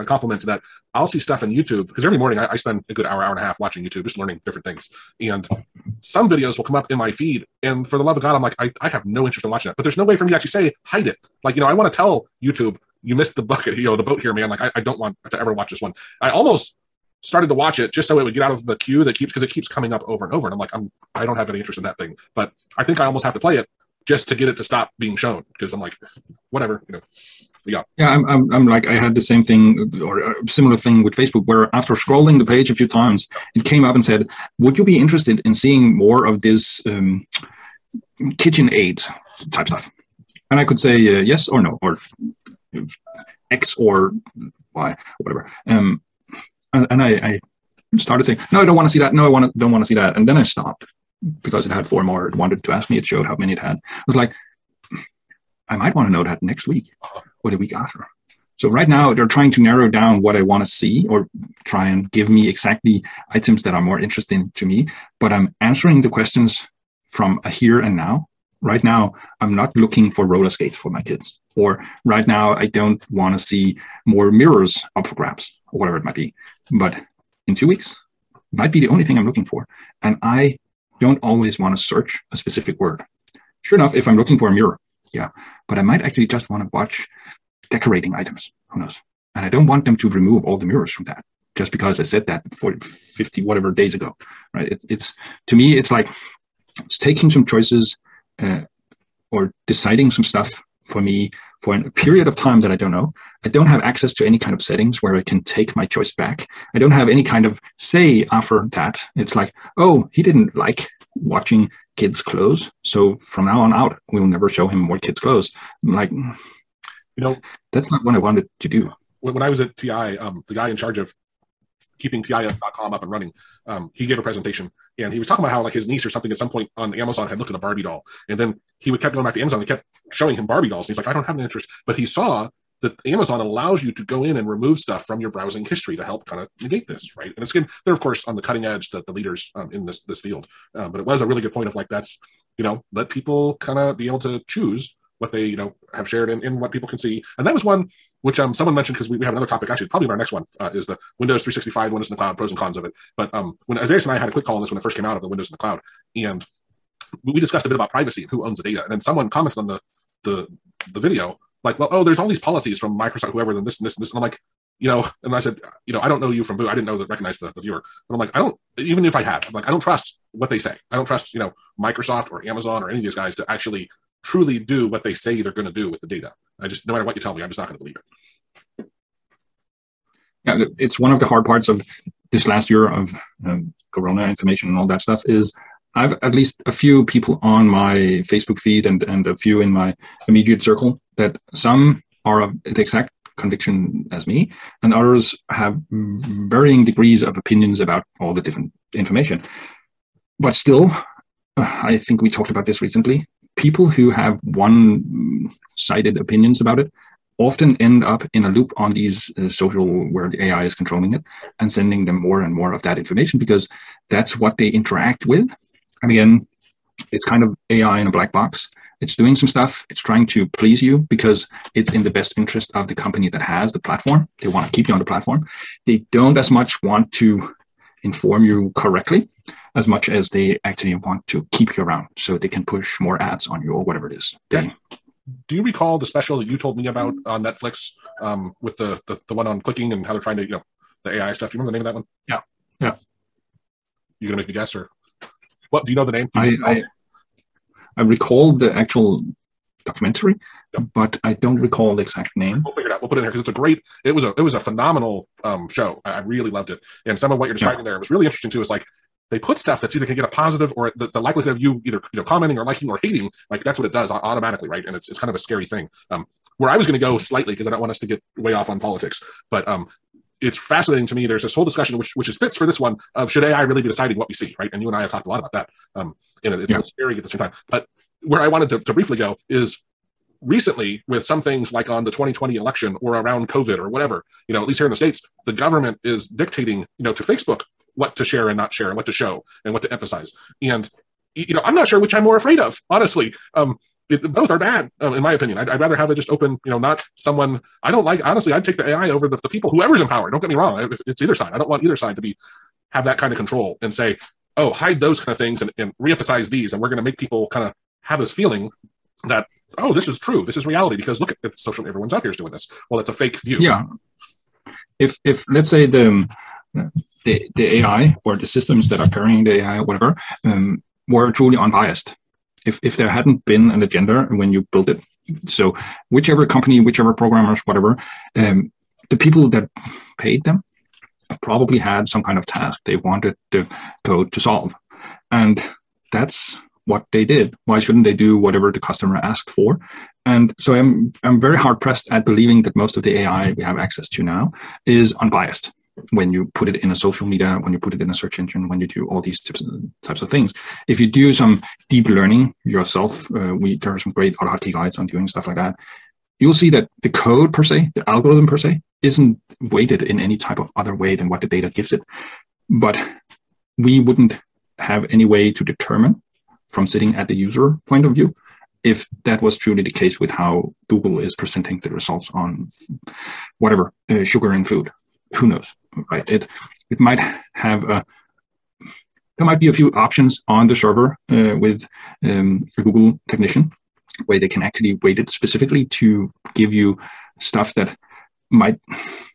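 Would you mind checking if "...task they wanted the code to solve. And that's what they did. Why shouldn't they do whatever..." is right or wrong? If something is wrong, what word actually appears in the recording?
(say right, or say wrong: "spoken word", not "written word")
right.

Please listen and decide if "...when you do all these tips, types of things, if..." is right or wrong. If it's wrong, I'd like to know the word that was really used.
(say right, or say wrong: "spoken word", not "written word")
right.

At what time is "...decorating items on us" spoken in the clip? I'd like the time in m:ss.
1:27.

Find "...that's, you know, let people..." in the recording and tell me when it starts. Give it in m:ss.
2:21.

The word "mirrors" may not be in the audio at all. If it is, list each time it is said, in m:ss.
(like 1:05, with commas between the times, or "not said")
1:14, 1:24, 1:30.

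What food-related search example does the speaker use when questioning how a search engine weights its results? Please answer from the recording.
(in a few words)
sugar in food.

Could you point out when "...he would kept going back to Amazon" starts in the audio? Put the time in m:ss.
2:08.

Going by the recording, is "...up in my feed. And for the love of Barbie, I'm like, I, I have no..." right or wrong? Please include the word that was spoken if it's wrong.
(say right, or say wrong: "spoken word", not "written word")
wrong: "God", not "Barbie".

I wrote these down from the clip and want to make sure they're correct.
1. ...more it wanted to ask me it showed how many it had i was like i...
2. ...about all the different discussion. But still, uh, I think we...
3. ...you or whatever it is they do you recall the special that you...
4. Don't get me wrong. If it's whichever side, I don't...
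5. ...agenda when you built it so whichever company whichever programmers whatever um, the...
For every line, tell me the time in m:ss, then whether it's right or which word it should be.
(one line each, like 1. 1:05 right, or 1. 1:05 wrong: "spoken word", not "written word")
1. 0:52 right
2. 3:17 wrong: "information", not "discussion"
3. 3:53 right
4. 5:00 wrong: "either", not "whichever"
5. 5:23 right.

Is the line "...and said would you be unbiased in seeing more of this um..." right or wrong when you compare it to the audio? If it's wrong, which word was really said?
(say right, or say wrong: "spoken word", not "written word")
wrong: "interested", not "unbiased".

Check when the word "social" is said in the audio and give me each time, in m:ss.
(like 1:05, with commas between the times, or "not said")
3:29, 5:11, 5:46.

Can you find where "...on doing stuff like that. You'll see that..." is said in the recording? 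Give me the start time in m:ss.
5:54.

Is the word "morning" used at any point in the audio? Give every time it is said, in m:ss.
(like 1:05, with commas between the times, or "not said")
0:02.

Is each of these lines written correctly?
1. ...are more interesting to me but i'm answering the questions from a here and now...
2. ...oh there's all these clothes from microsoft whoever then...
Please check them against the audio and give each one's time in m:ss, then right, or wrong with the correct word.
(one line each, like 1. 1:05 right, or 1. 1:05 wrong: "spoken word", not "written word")
1. 1:03 right
2. 2:41 wrong: "policies", not "clothes".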